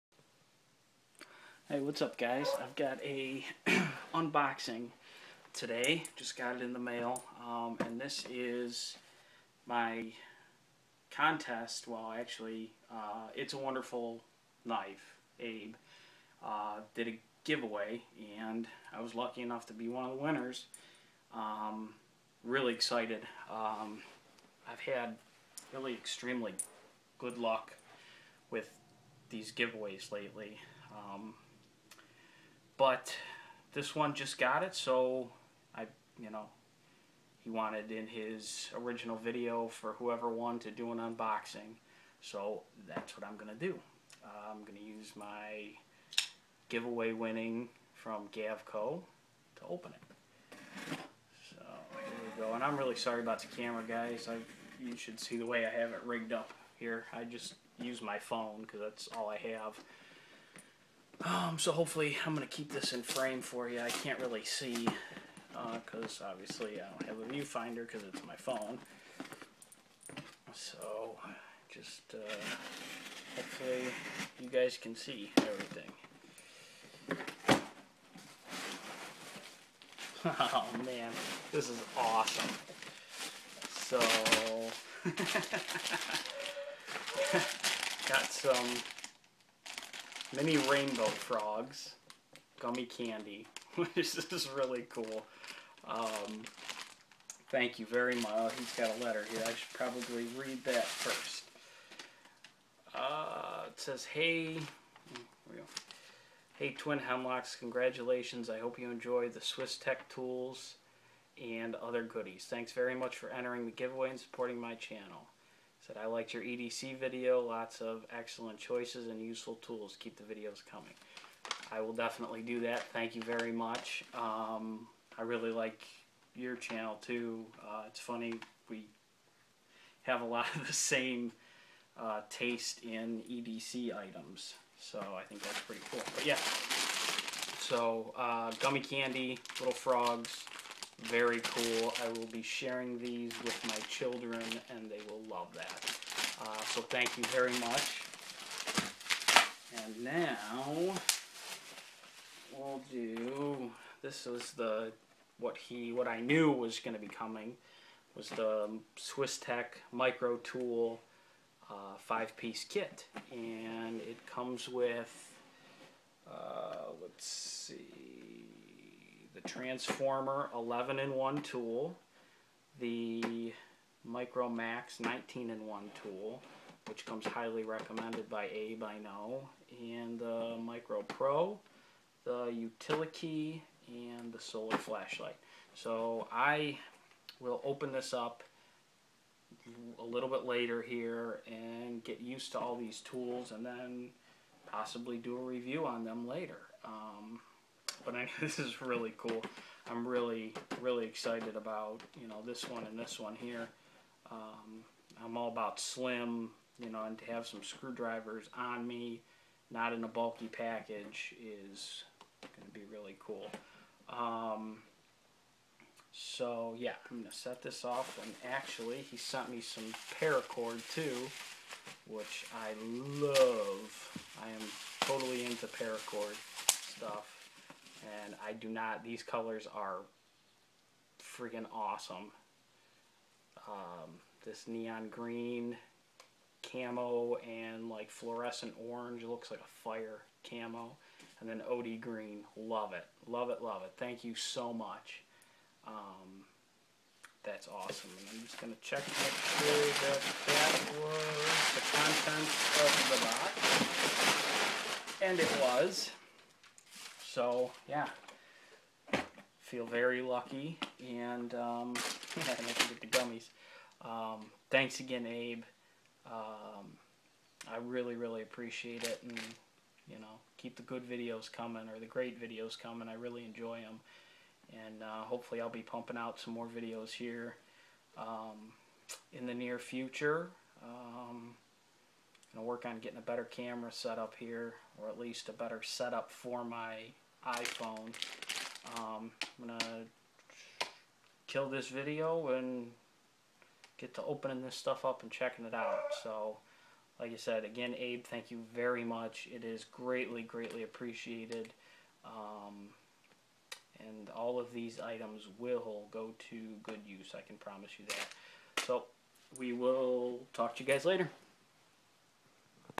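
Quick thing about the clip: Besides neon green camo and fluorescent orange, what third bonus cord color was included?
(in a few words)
OD green.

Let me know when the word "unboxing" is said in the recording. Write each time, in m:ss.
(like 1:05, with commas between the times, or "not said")
0:04, 0:40.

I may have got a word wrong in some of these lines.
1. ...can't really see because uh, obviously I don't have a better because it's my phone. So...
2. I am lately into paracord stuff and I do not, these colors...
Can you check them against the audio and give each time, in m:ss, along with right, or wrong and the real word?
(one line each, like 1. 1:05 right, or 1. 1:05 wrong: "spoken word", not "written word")
1. 1:03 wrong: "viewfinder", not "better"
2. 3:44 wrong: "totally", not "lately".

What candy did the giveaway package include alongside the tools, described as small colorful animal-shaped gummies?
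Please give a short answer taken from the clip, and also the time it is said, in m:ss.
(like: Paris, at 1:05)
Mini rainbow frogs, at 1:30.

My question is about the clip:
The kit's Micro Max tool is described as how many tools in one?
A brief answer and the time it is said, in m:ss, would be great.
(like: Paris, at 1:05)
19, at 2:54.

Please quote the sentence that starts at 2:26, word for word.
Uh, so thank you very much.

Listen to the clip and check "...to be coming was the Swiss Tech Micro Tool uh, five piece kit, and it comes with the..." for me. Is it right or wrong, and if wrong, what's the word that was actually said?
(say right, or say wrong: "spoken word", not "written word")
right.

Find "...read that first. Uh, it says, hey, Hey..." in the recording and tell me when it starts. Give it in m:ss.
1:40.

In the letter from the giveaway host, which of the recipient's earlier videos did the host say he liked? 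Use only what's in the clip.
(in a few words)
EDC video.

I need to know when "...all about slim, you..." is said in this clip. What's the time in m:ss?
3:25.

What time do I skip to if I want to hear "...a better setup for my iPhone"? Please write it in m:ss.
4:45.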